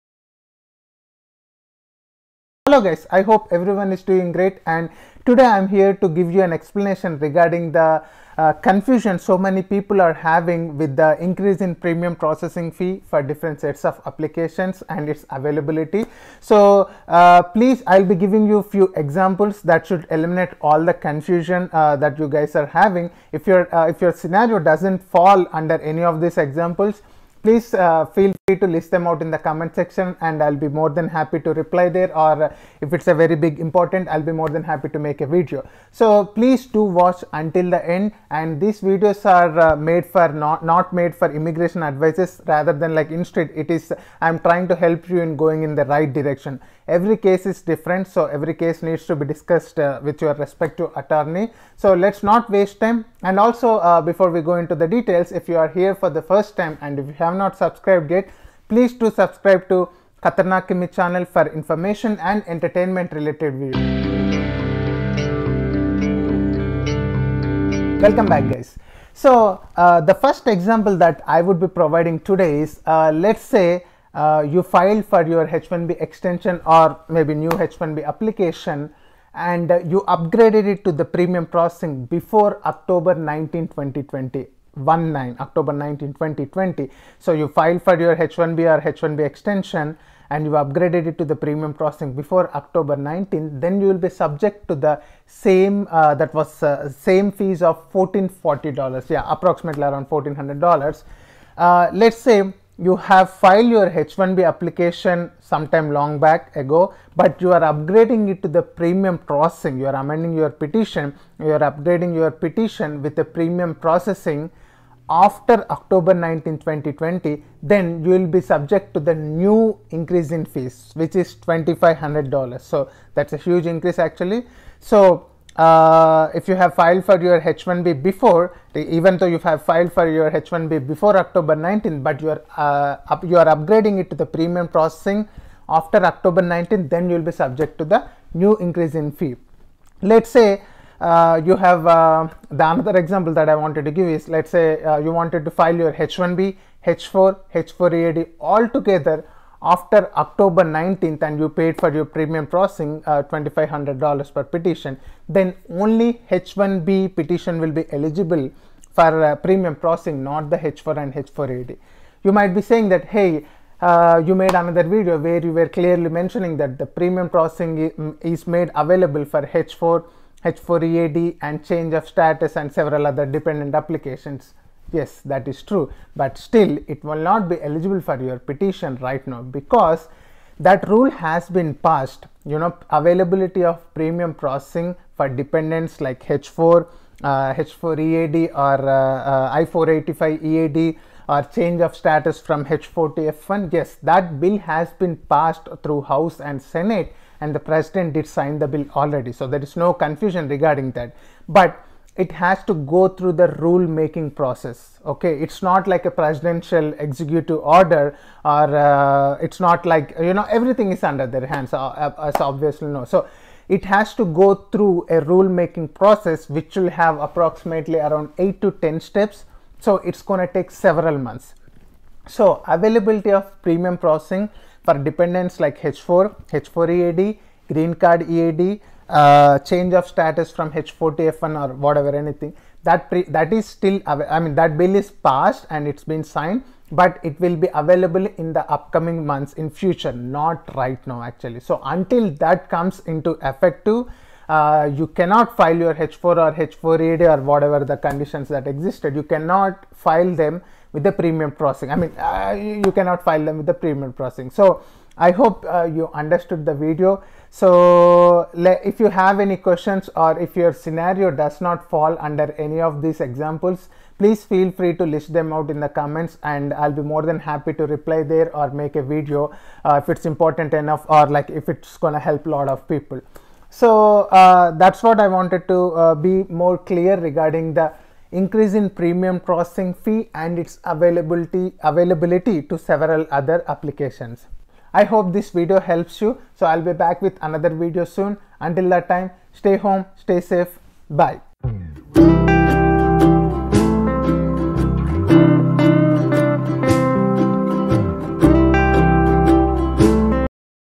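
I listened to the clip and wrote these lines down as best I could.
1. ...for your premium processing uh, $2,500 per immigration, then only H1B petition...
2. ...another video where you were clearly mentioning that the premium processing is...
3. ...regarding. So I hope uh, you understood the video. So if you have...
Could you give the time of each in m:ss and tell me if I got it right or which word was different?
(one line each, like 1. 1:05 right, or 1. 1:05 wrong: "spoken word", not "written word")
1. 2:31 wrong: "petition", not "immigration"
2. 2:44 right
3. 4:14 wrong: "processing", not "regarding".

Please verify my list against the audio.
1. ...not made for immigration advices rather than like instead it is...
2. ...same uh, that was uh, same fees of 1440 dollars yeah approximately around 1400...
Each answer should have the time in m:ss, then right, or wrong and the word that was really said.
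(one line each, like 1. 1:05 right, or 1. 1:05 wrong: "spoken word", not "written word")
1. 0:40 right
2. 1:35 right.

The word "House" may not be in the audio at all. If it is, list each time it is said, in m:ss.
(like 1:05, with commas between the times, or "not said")
3:16.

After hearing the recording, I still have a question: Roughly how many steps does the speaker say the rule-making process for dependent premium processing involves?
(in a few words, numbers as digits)
8 to 10.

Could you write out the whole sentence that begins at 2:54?
Yes, that is true, but still it will not be eligible for your petition right now because that rule has been passed.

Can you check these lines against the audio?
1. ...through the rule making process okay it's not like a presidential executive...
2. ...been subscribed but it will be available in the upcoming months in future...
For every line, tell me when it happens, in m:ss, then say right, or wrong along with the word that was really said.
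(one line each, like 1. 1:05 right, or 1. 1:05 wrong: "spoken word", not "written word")
1. 3:23 right
2. 3:56 wrong: "signed", not "subscribed".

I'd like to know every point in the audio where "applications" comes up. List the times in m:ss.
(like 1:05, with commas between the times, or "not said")
0:14, 1:18, 1:44, 2:53, 4:43.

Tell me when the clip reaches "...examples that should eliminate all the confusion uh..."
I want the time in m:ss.
0:18.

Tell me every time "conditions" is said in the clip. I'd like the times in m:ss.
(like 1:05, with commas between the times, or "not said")
4:07.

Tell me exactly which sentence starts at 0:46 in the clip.
Every case is different so every case needs to be discussed uh, with your respective attorney.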